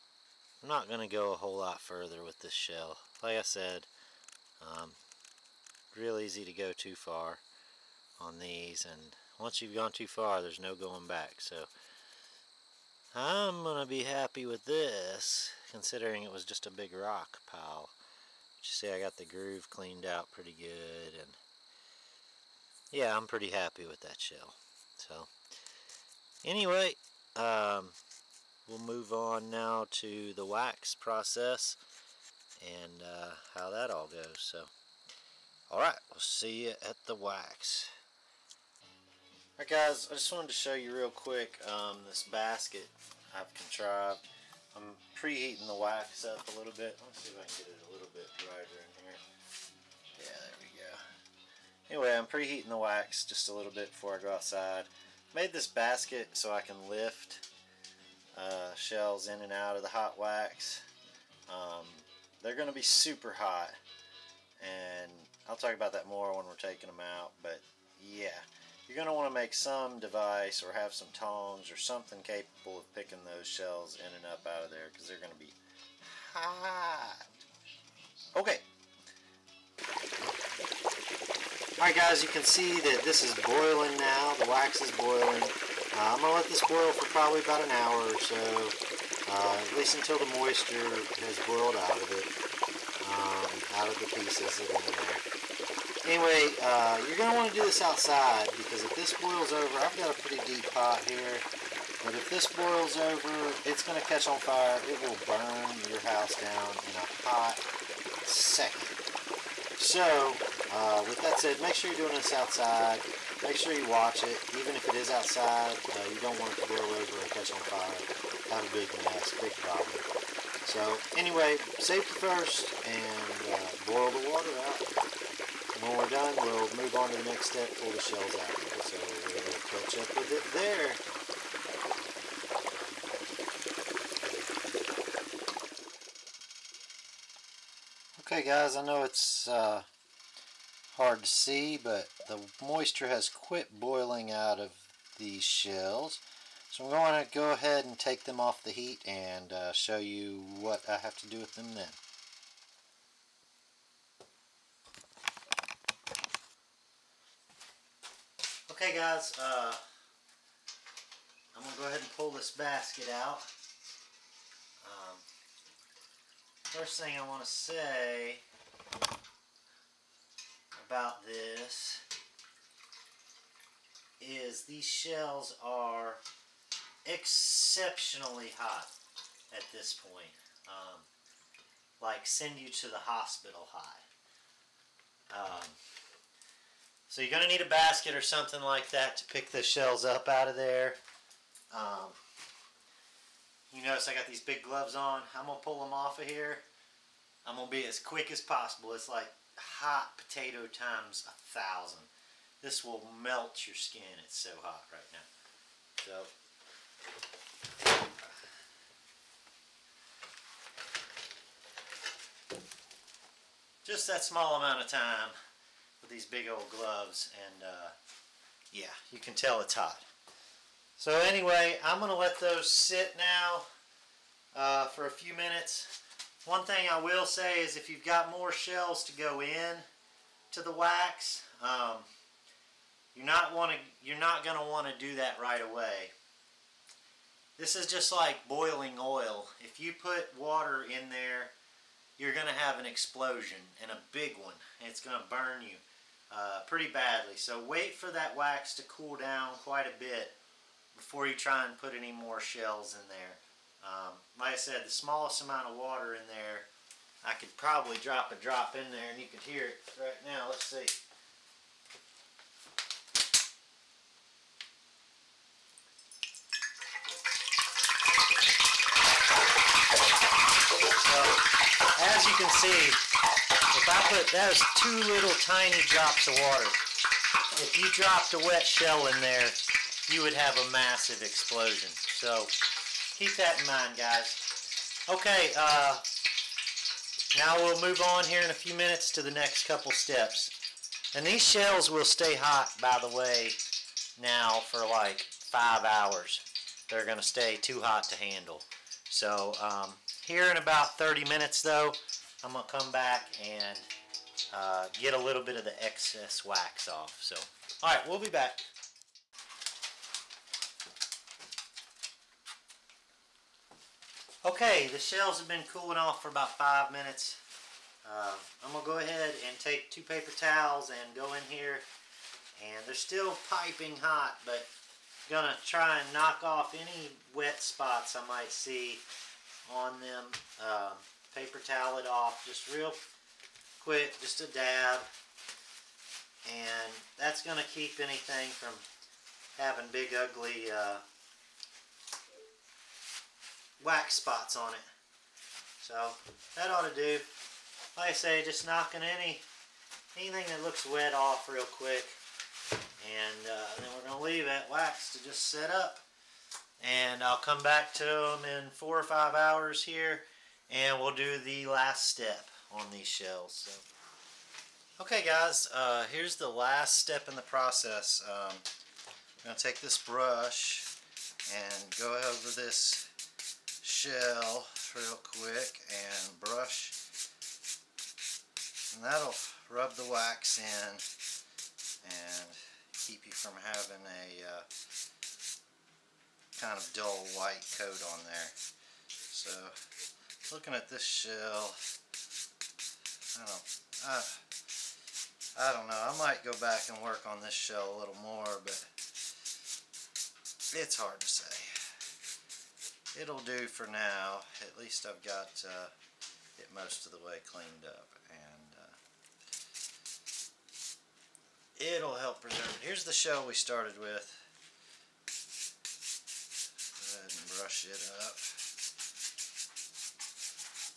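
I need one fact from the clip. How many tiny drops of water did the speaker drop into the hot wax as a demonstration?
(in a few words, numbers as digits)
2.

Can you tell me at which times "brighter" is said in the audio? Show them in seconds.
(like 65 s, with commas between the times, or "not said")
48 s.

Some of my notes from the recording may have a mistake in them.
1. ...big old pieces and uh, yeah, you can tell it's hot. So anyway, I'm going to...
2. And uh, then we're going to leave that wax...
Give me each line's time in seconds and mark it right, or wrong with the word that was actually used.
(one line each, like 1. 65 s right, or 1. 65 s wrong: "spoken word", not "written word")
1. 216 s wrong: "gloves", not "pieces"
2. 352 s right.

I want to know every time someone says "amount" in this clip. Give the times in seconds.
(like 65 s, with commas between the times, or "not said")
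214 s, 255 s.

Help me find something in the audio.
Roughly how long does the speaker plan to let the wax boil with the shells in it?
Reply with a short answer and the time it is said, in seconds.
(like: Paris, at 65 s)
about an hour, at 87 s.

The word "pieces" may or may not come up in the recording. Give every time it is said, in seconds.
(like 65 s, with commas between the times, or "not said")
94 s.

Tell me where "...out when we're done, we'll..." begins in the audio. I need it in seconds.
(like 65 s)
124 s.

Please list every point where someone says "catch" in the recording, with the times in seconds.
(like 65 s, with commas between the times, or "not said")
104 s, 117 s, 129 s.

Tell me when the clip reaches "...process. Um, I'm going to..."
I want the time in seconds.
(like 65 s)
367 s.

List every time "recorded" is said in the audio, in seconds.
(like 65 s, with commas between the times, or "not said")
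not said.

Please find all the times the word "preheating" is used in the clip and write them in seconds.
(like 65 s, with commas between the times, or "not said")
45 s, 52 s.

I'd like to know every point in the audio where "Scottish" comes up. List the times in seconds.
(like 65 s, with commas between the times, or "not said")
not said.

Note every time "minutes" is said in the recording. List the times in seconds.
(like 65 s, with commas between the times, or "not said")
225 s, 288 s, 301 s, 316 s.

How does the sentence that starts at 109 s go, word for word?
So, uh, with that said, make sure you're doing this outside.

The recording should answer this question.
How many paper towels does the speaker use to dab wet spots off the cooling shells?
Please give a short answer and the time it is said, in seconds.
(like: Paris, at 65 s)
2, at 319 s.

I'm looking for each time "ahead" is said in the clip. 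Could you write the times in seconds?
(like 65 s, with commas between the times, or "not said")
147 s, 161 s, 318 s, 417 s.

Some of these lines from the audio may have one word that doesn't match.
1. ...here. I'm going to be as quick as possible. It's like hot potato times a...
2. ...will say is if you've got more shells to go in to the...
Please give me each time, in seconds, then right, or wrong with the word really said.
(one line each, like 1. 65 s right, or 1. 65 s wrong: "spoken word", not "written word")
1. 196 s right
2. 227 s right.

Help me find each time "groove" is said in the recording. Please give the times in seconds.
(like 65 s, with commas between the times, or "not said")
19 s.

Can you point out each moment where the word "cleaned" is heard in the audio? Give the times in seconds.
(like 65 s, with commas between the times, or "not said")
19 s, 407 s.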